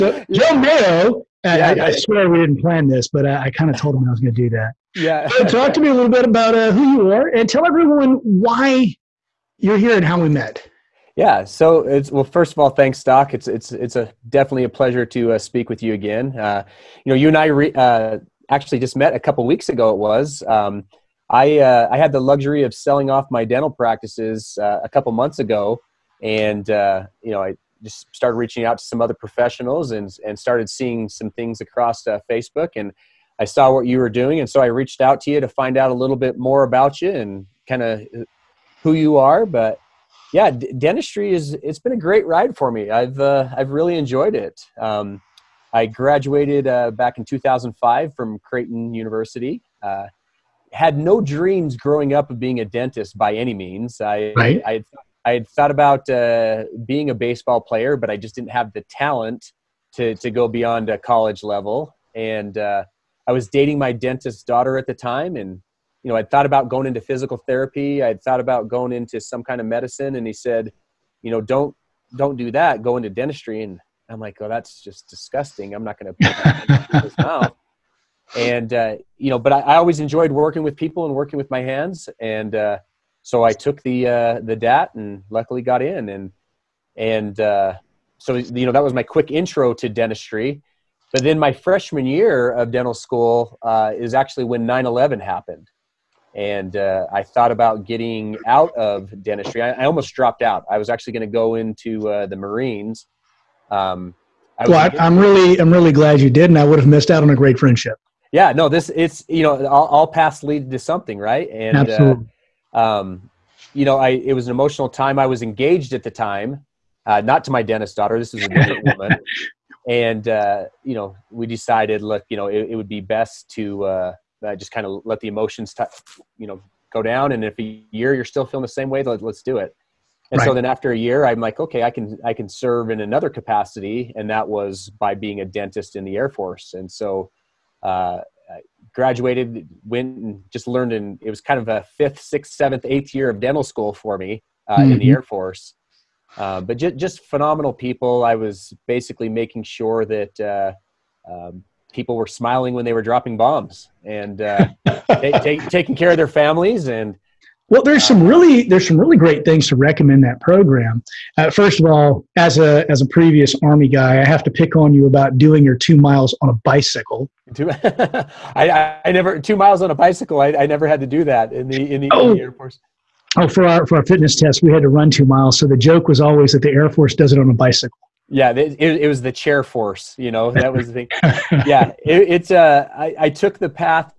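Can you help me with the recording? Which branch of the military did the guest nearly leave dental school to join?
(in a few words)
the Marines.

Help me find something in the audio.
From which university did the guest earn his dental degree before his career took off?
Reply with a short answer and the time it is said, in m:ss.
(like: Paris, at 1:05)
Creighton University, at 0:48.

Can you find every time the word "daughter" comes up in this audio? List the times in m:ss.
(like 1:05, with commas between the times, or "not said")
1:04, 1:57.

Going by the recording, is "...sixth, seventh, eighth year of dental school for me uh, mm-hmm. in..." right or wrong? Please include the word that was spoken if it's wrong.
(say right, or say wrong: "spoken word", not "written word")
right.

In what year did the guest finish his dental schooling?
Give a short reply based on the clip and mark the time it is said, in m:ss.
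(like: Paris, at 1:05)
2005, at 0:47.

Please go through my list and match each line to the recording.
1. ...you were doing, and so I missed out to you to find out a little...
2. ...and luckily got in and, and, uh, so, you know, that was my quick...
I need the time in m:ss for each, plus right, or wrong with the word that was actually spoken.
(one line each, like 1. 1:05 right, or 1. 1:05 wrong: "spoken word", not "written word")
1. 0:33 wrong: "reached", not "missed"
2. 1:24 right.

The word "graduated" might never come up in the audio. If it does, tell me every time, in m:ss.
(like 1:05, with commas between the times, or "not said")
0:45, 2:18.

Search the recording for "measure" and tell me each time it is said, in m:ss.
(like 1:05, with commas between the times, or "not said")
not said.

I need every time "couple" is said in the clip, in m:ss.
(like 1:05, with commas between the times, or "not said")
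0:19, 0:24.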